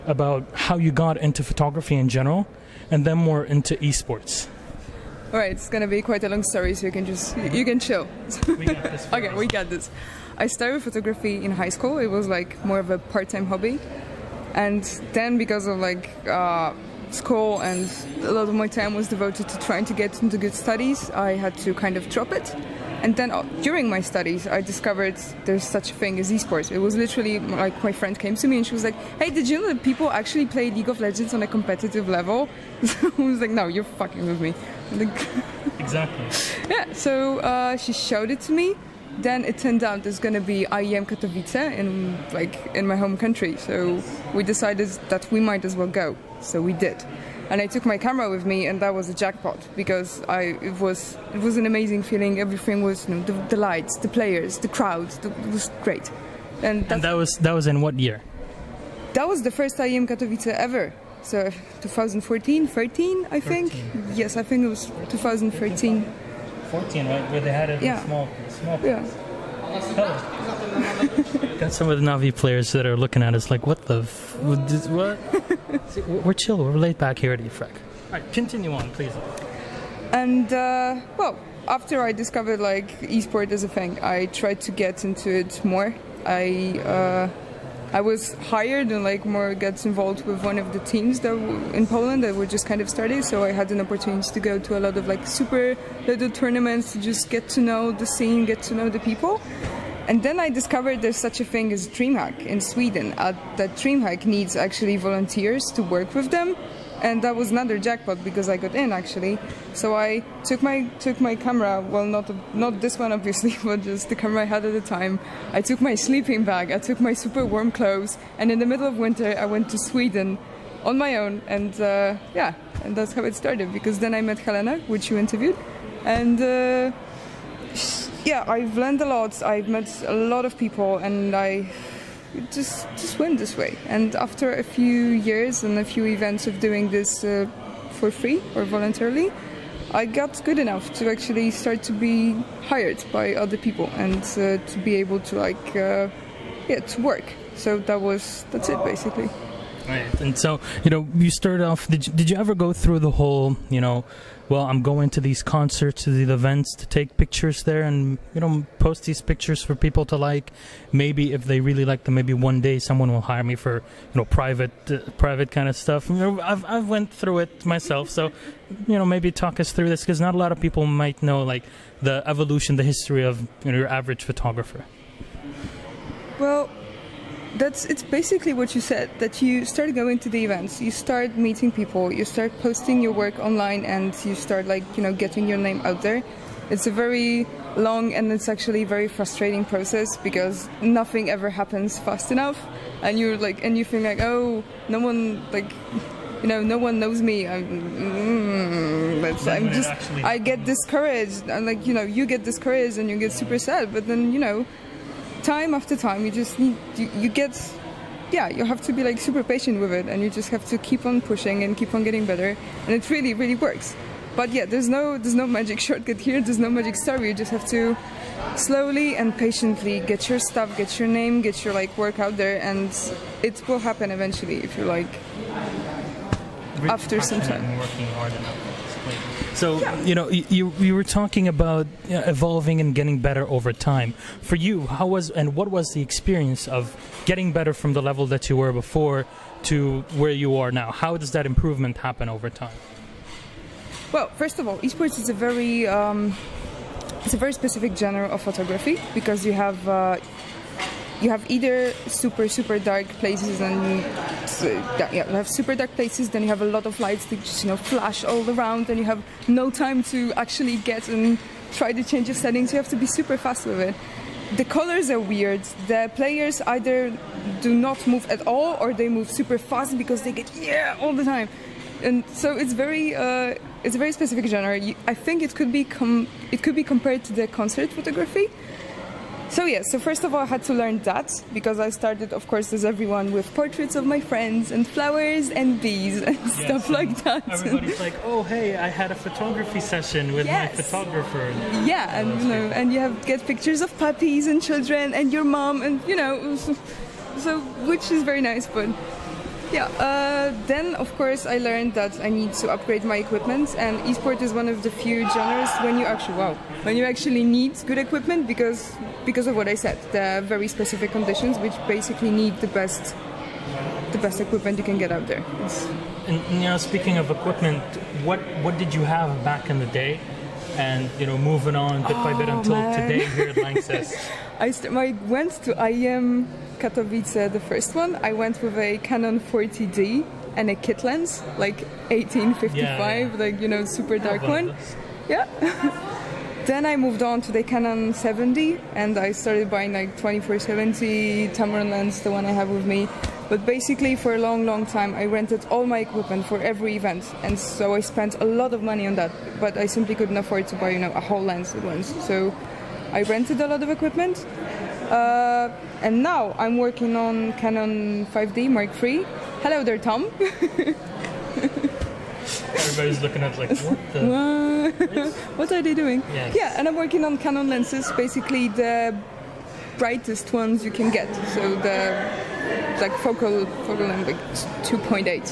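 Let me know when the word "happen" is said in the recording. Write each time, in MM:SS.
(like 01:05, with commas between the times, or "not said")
03:11, 03:43, 04:01.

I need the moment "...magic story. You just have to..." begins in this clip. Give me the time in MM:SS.
03:36.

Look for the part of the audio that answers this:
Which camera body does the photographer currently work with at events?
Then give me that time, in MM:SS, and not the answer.
05:57.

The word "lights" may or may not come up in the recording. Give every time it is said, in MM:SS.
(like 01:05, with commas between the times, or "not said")
00:53, 04:17.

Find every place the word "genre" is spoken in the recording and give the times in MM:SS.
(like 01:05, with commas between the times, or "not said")
04:07, 04:34, 05:05.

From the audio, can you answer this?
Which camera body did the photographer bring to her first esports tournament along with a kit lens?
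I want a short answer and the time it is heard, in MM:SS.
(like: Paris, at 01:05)
Canon 40D, at 05:28.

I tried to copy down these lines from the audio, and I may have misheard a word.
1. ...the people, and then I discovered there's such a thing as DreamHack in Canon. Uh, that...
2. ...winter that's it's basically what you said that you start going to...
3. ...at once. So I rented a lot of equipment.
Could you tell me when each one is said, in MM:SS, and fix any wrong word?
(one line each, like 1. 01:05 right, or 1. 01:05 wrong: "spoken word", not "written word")
1. 01:38 wrong: "Sweden", not "Canon"
2. 02:54 wrong: "photographer", not "winter"
3. 05:51 right.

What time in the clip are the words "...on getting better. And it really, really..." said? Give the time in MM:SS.
03:31.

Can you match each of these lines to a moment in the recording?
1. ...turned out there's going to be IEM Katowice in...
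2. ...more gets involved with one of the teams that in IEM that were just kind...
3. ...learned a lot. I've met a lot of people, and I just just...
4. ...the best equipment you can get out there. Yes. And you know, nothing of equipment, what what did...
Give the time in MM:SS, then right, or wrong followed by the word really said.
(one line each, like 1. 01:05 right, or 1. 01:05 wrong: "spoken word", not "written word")
1. 00:39 right
2. 01:29 wrong: "Poland", not "IEM"
3. 02:08 right
4. 05:14 wrong: "speaking", not "nothing".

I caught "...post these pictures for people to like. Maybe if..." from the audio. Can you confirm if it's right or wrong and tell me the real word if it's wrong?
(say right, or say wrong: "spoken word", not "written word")
right.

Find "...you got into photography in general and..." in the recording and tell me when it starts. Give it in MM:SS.
00:00.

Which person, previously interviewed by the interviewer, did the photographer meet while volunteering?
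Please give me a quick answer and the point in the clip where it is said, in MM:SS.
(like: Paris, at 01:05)
Helena, at 02:04.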